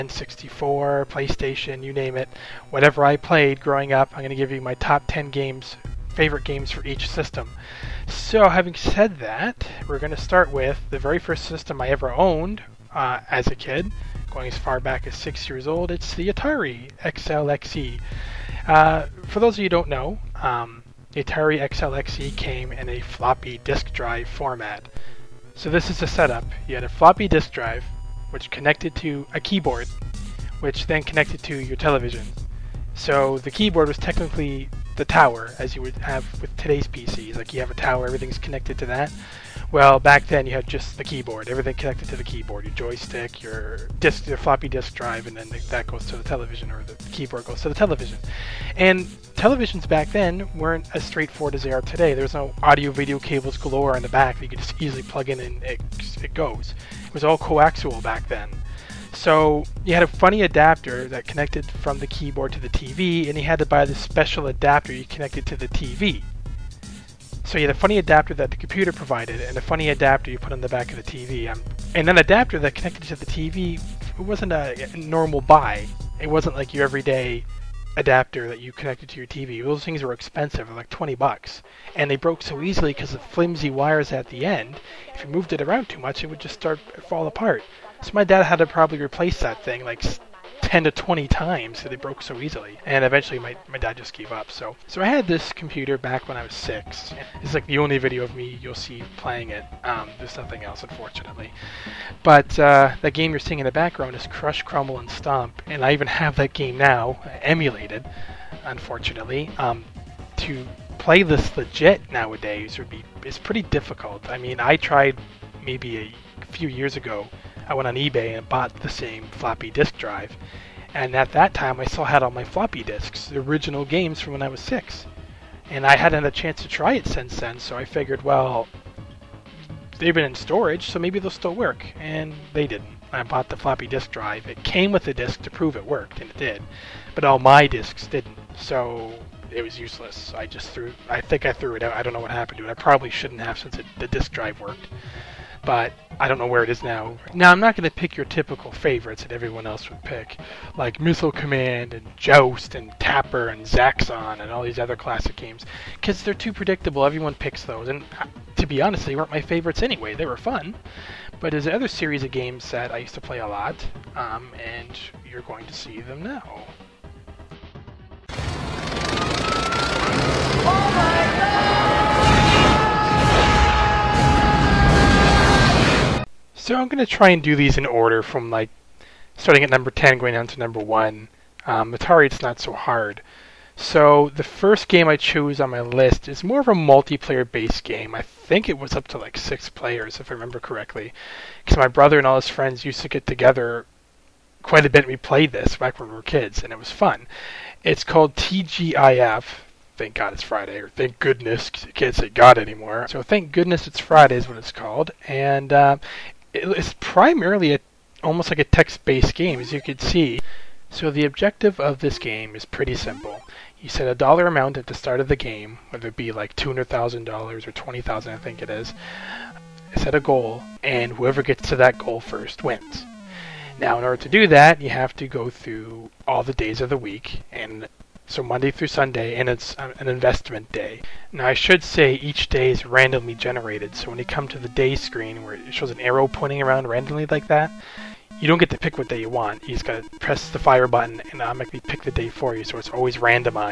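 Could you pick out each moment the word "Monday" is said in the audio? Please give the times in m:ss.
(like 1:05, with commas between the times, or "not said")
3:48.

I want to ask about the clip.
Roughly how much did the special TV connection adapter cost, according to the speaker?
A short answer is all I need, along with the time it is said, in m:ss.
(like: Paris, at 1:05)
$20, at 1:20.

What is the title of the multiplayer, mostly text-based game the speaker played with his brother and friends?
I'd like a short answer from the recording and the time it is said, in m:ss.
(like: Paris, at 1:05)
TGIF, at 3:18.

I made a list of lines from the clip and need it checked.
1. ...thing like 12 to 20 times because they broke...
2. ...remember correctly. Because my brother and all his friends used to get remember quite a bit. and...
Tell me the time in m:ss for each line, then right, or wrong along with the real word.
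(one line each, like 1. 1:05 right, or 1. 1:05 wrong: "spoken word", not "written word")
1. 1:29 wrong: "10", not "12"
2. 3:10 wrong: "together", not "remember".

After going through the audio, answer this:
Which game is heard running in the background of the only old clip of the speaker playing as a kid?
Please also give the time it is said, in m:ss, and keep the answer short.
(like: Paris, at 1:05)
Crush, Crumble, and Stomp, at 1:44.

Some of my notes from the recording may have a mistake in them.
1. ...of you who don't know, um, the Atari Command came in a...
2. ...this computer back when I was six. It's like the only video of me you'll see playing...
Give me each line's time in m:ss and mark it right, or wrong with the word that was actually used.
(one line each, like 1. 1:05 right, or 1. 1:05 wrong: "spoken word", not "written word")
1. 0:19 wrong: "XLXE", not "Command"
2. 1:35 right.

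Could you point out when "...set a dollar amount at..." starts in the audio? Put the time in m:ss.
3:33.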